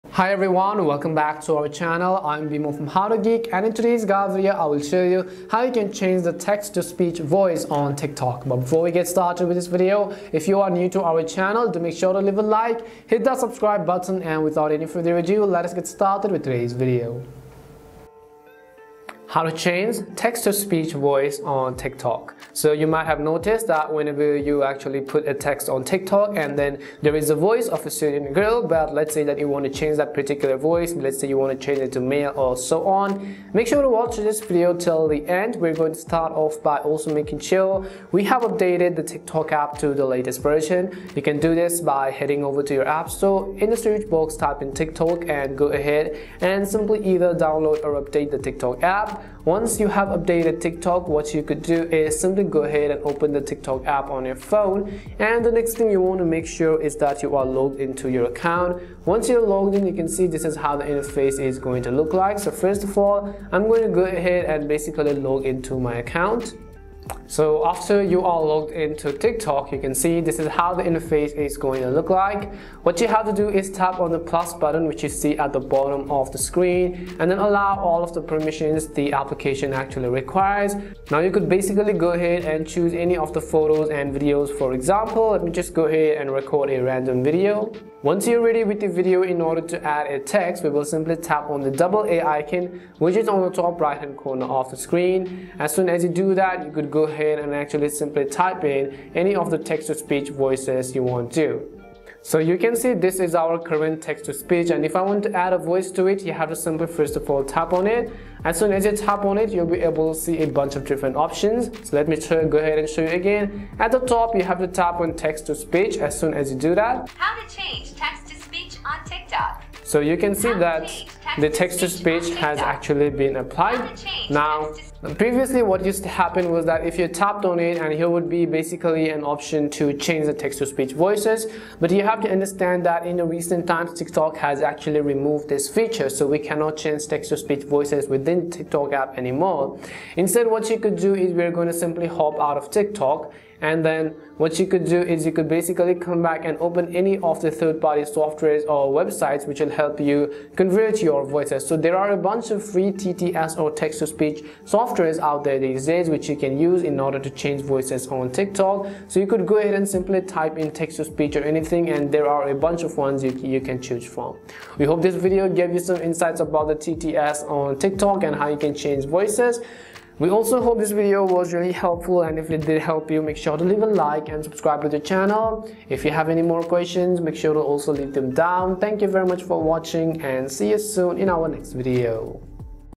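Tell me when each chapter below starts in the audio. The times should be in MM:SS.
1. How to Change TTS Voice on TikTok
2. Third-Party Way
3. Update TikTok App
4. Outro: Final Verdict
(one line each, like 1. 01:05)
1. 01:13
2. 02:20
3. 00:19
4. 02:50.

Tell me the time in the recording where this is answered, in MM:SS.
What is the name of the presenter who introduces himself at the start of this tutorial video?
00:02.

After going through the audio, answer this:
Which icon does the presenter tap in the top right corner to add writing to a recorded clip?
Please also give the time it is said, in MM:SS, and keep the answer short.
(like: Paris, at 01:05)
double A icon, at 01:31.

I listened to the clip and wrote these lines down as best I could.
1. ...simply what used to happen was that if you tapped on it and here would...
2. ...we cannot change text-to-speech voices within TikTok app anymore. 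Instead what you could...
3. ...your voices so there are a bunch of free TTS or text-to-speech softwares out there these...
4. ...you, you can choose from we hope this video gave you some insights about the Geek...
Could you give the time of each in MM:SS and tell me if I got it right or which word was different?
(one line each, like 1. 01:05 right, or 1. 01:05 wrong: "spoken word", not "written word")
1. 02:05 wrong: "previously", not "simply"
2. 02:16 right
3. 02:31 right
4. 02:43 wrong: "TTS", not "Geek".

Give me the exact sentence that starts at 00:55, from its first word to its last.
And the next thing you want to make sure is that you are logged into your account.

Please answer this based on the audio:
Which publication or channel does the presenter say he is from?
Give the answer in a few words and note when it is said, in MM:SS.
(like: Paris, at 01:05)
How to Geek, at 00:02.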